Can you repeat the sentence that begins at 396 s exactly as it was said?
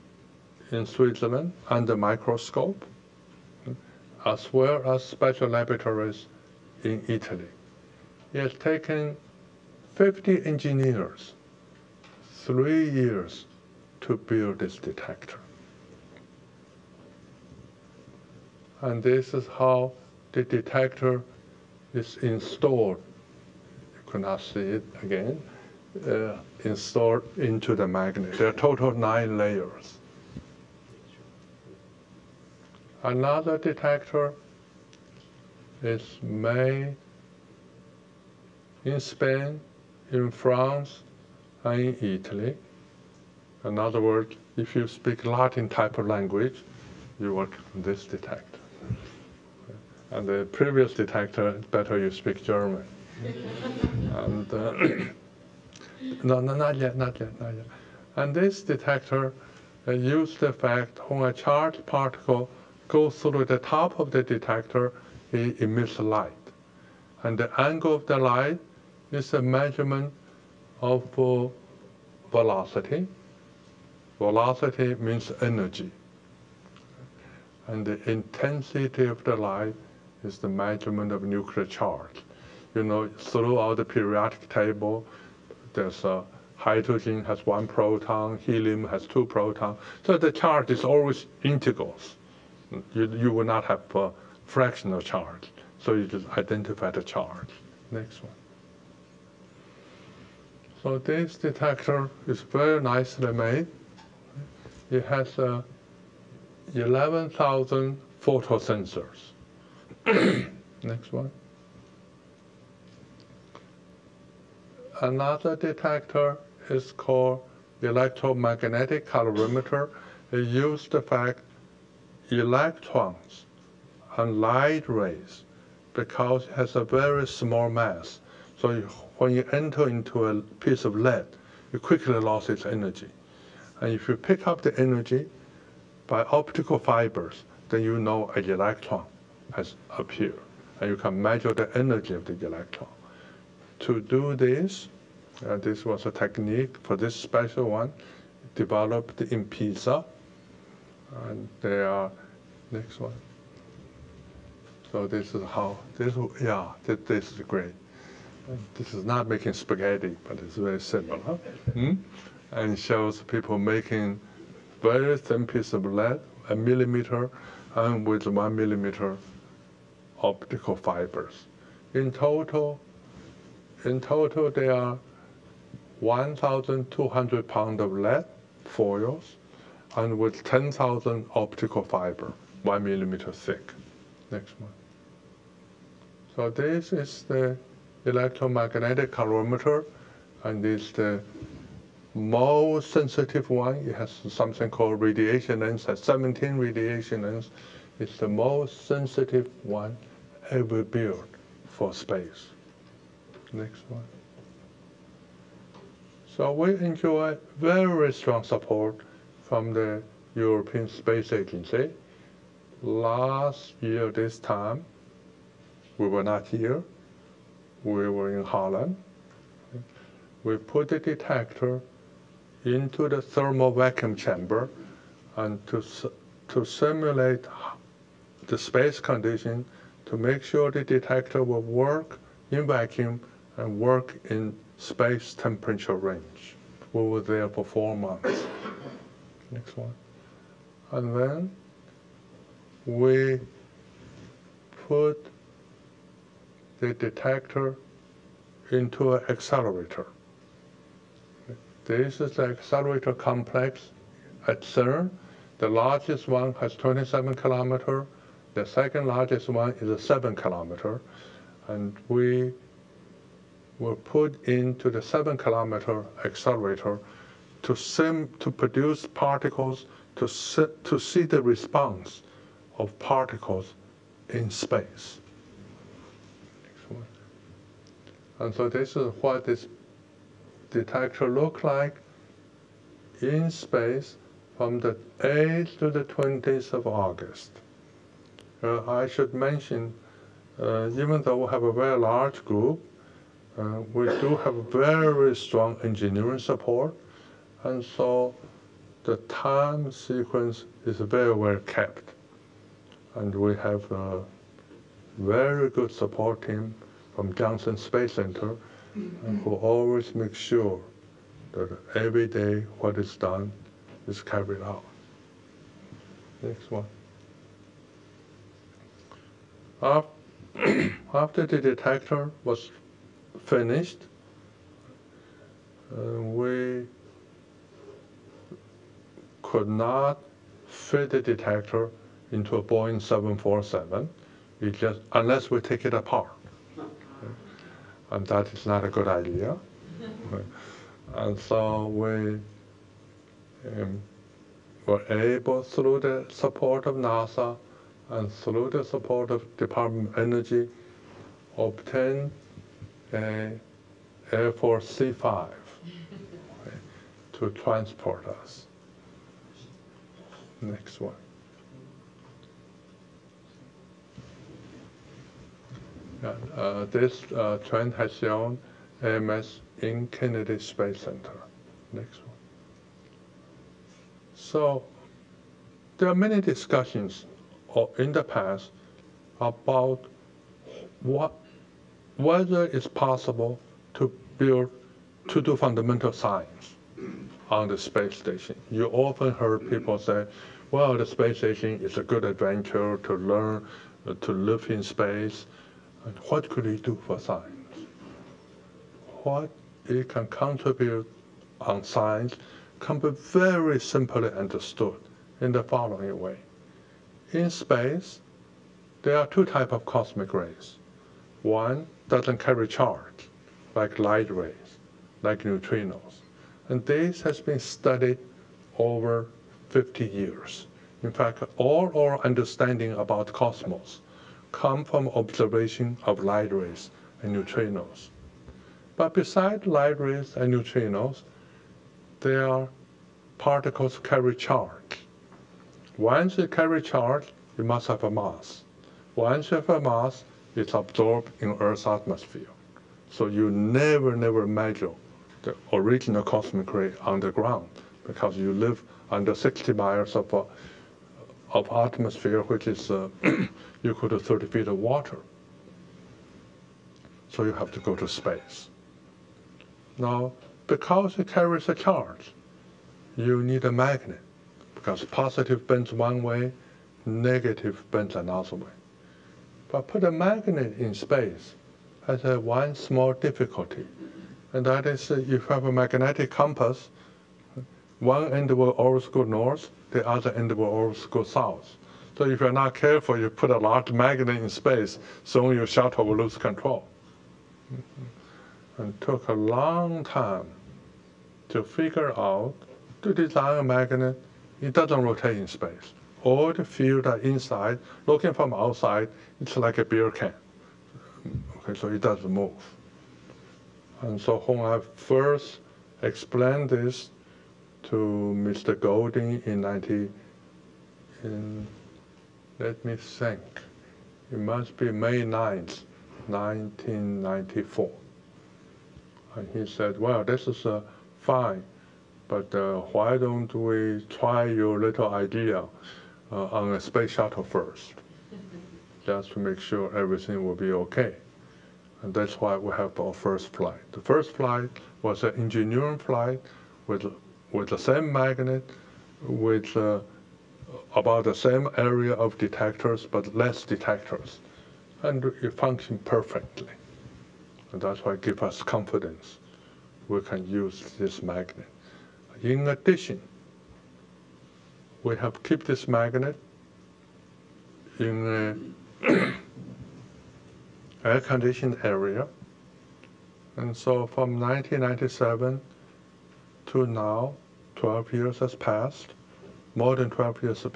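And what could it do for science?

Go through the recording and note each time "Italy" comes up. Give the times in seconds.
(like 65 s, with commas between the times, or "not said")
7 s, 42 s.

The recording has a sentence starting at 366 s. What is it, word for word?
uh, this uh, trend has shown AMS in Kennedy Space Center.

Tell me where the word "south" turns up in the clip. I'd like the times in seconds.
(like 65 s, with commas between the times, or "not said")
481 s.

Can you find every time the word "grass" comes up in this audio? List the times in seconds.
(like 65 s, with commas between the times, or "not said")
not said.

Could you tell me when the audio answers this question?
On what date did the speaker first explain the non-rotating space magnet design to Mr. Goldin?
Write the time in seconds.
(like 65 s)
514 s.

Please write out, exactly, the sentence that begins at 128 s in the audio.
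So when you enter into a piece of lead, you quickly lose its energy.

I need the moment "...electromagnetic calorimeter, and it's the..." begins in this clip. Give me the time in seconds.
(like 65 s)
188 s.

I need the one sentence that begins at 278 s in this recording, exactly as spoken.
And so this is what this detector look like in space from the 8th to the 20th of August.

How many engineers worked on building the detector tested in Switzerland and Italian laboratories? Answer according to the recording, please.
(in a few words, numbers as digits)
50.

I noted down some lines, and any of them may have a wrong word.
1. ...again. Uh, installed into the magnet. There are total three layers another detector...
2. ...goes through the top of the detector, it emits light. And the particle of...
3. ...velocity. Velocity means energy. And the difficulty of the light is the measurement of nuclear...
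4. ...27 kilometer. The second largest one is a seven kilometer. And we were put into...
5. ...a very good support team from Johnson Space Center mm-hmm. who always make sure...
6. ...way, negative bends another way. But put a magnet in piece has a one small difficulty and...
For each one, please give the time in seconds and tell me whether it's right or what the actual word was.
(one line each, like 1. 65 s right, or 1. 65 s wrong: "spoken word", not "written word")
1. 25 s wrong: "nine", not "three"
2. 62 s wrong: "angle", not "particle"
3. 72 s wrong: "intensity", not "difficulty"
4. 256 s right
5. 303 s right
6. 466 s wrong: "space", not "piece".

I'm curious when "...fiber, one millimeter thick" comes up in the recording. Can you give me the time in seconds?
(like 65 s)
181 s.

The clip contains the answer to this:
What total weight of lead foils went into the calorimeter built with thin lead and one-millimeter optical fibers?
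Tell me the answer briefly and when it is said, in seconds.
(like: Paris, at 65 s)
1,200 pounds, at 176 s.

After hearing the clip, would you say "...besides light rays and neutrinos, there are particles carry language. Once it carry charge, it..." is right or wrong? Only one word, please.
wrong.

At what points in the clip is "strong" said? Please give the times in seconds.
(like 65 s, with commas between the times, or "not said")
208 s, 295 s.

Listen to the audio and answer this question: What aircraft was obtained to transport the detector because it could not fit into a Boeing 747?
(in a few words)
Air Force C-5.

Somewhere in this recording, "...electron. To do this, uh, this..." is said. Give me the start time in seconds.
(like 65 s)
142 s.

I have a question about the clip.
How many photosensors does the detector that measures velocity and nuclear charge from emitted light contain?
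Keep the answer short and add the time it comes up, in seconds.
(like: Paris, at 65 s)
11,000, at 106 s.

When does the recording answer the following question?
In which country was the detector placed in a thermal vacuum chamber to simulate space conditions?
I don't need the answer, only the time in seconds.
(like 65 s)
218 s.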